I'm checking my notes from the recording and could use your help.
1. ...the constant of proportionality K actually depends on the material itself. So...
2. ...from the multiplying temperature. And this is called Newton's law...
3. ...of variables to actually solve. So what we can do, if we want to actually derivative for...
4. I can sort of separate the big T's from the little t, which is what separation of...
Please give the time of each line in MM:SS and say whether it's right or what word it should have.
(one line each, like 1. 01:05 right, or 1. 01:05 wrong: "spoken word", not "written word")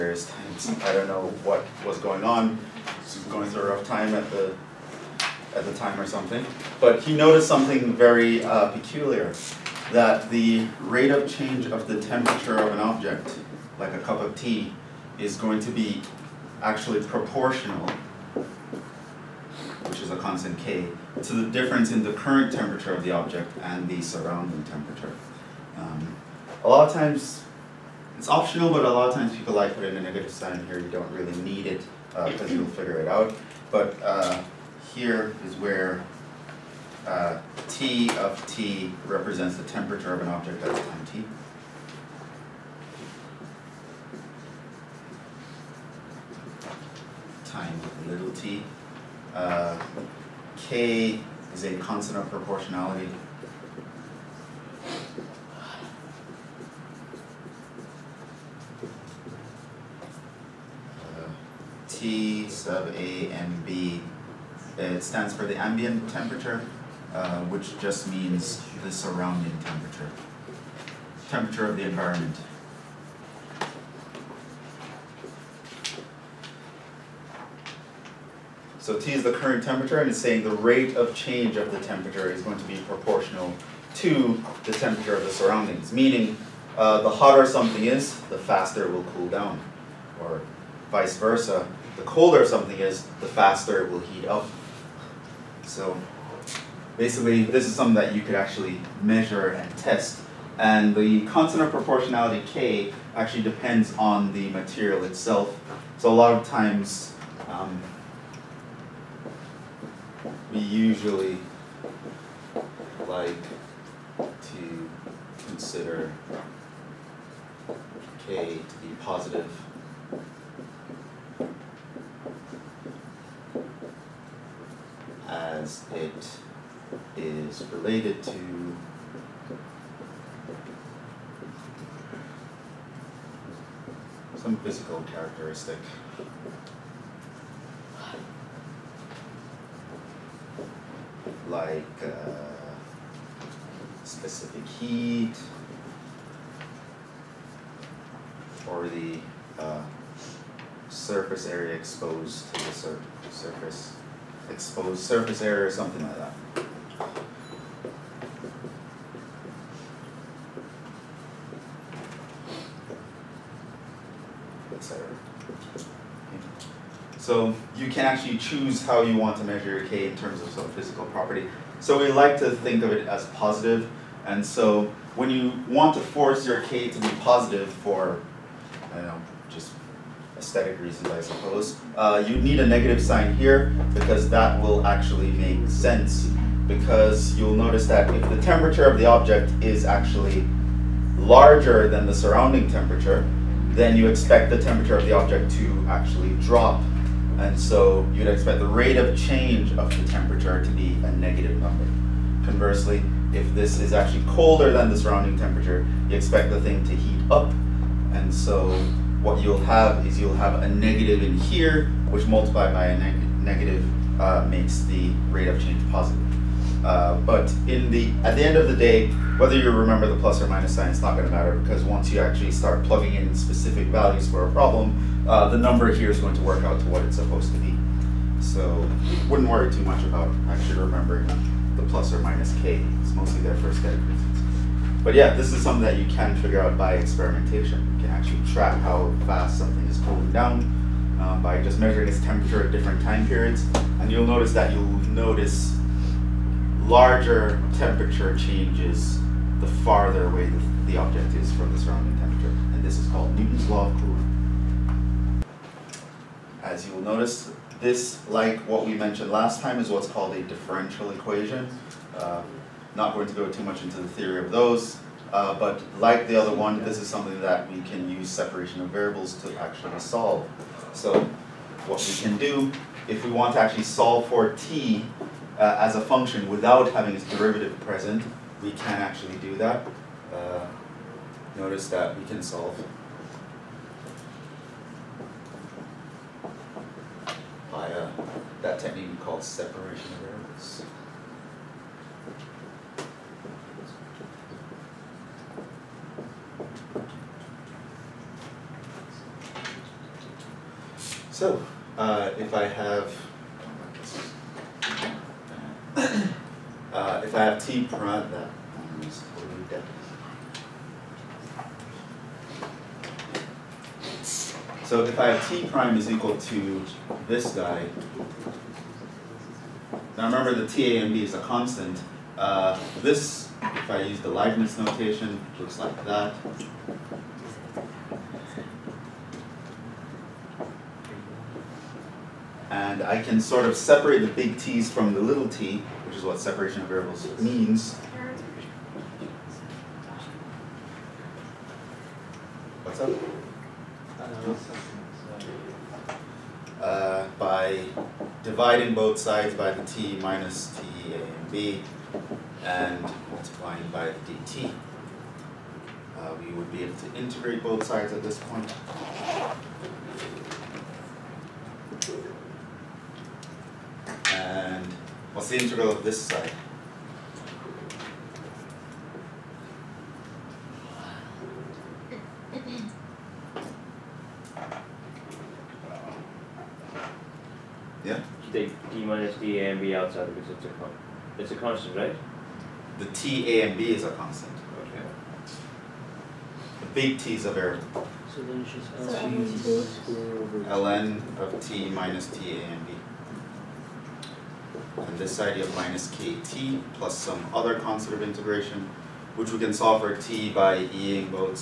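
1. 01:40 right
2. 04:11 wrong: "surrounding", not "multiplying"
3. 04:28 wrong: "solve", not "derivative"
4. 05:33 right.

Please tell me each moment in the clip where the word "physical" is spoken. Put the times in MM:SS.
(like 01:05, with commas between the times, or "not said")
02:14, 02:50.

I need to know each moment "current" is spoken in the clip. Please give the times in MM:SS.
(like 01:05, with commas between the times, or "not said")
00:22, 01:19.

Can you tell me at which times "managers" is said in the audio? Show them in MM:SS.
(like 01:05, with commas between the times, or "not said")
not said.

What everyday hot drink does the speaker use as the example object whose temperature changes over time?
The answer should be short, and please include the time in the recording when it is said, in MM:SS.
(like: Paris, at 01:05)
A cup of tea, at 00:13.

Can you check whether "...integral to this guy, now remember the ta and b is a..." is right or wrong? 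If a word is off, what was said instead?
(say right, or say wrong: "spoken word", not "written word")
wrong: "equal", not "integral".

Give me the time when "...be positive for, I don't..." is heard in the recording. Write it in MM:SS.
02:56.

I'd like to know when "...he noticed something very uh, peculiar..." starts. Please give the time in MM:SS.
00:07.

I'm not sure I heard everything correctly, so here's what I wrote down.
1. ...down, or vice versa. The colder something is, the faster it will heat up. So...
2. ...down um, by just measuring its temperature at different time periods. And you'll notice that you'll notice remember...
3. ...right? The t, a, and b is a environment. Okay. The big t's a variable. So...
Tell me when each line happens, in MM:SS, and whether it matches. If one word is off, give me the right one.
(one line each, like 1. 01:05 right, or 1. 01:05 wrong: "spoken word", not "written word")
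1. 01:29 right
2. 04:00 wrong: "larger", not "remember"
3. 06:21 wrong: "constant", not "environment".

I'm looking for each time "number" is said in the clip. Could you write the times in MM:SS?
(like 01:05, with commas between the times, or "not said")
03:21, 03:45.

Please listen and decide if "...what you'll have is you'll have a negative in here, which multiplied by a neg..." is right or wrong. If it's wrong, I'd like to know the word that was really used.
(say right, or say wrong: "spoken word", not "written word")
right.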